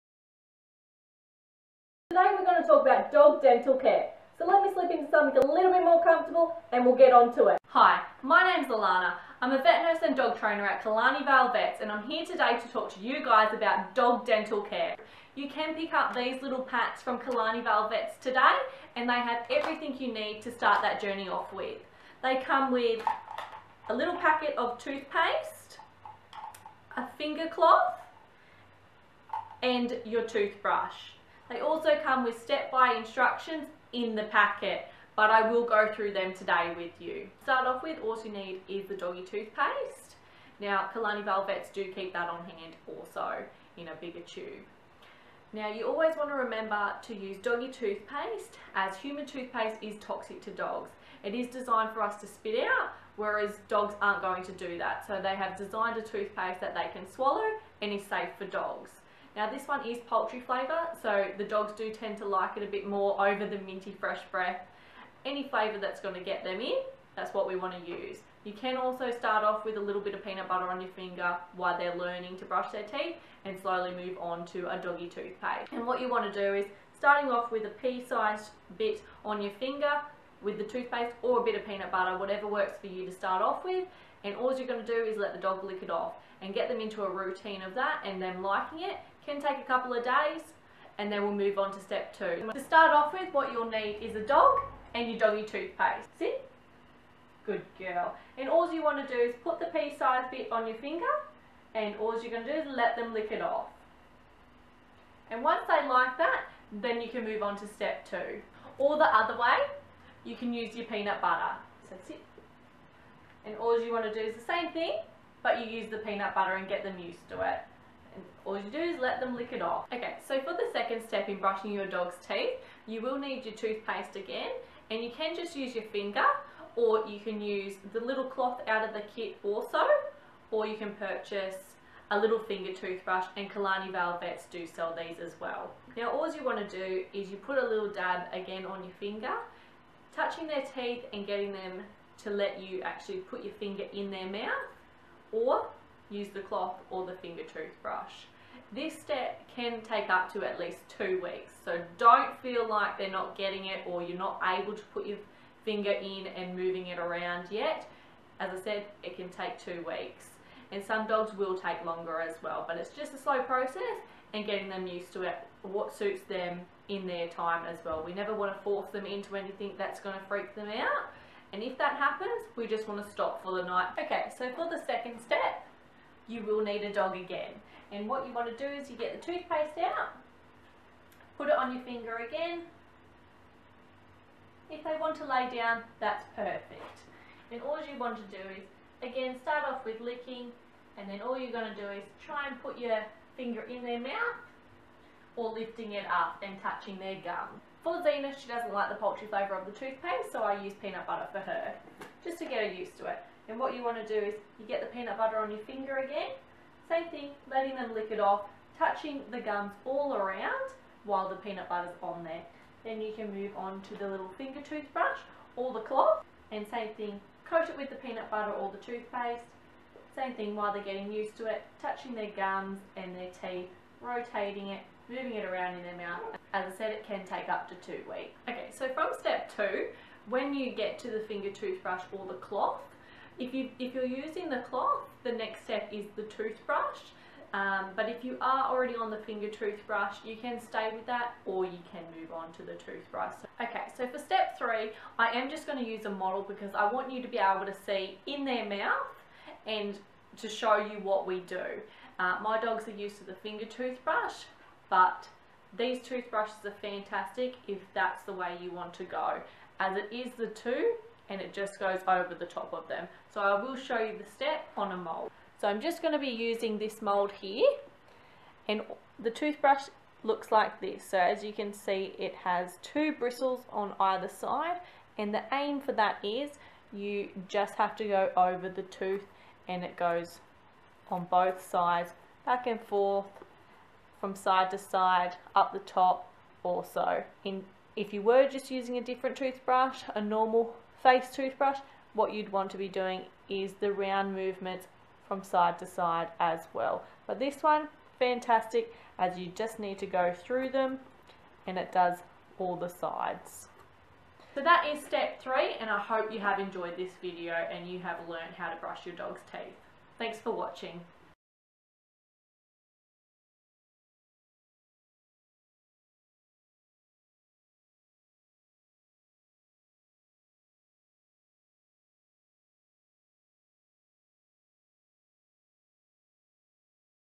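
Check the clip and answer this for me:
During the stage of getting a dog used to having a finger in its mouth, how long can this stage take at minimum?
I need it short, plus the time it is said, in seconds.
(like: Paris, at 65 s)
2 weeks, at 150 s.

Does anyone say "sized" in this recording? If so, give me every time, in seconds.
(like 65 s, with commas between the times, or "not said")
77 s, 99 s.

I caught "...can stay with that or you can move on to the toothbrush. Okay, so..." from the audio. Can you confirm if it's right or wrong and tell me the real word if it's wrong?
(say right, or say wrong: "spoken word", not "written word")
right.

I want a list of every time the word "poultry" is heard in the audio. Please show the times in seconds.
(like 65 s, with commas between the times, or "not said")
60 s, 198 s.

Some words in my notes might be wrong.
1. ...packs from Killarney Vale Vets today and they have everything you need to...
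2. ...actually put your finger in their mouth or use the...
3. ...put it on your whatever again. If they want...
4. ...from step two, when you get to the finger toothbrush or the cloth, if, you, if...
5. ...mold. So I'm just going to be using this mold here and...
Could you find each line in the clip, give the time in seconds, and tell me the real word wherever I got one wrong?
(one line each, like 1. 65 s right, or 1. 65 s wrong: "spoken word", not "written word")
1. 16 s right
2. 142 s right
3. 181 s wrong: "finger", not "whatever"
4. 228 s right
5. 264 s right.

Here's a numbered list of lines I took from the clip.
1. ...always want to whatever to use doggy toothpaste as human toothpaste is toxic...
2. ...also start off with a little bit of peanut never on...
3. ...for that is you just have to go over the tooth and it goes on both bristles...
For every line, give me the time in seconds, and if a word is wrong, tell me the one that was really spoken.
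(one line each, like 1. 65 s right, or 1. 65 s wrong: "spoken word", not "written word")
1. 45 s wrong: "remember", not "whatever"
2. 68 s wrong: "butter", not "never"
3. 275 s wrong: "sides", not "bristles".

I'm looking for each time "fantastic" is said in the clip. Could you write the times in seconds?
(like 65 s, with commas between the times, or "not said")
256 s, 298 s.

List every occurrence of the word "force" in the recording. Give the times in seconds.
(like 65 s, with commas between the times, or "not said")
168 s.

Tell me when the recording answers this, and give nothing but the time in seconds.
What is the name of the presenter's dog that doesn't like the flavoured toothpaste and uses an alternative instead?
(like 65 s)
197 s.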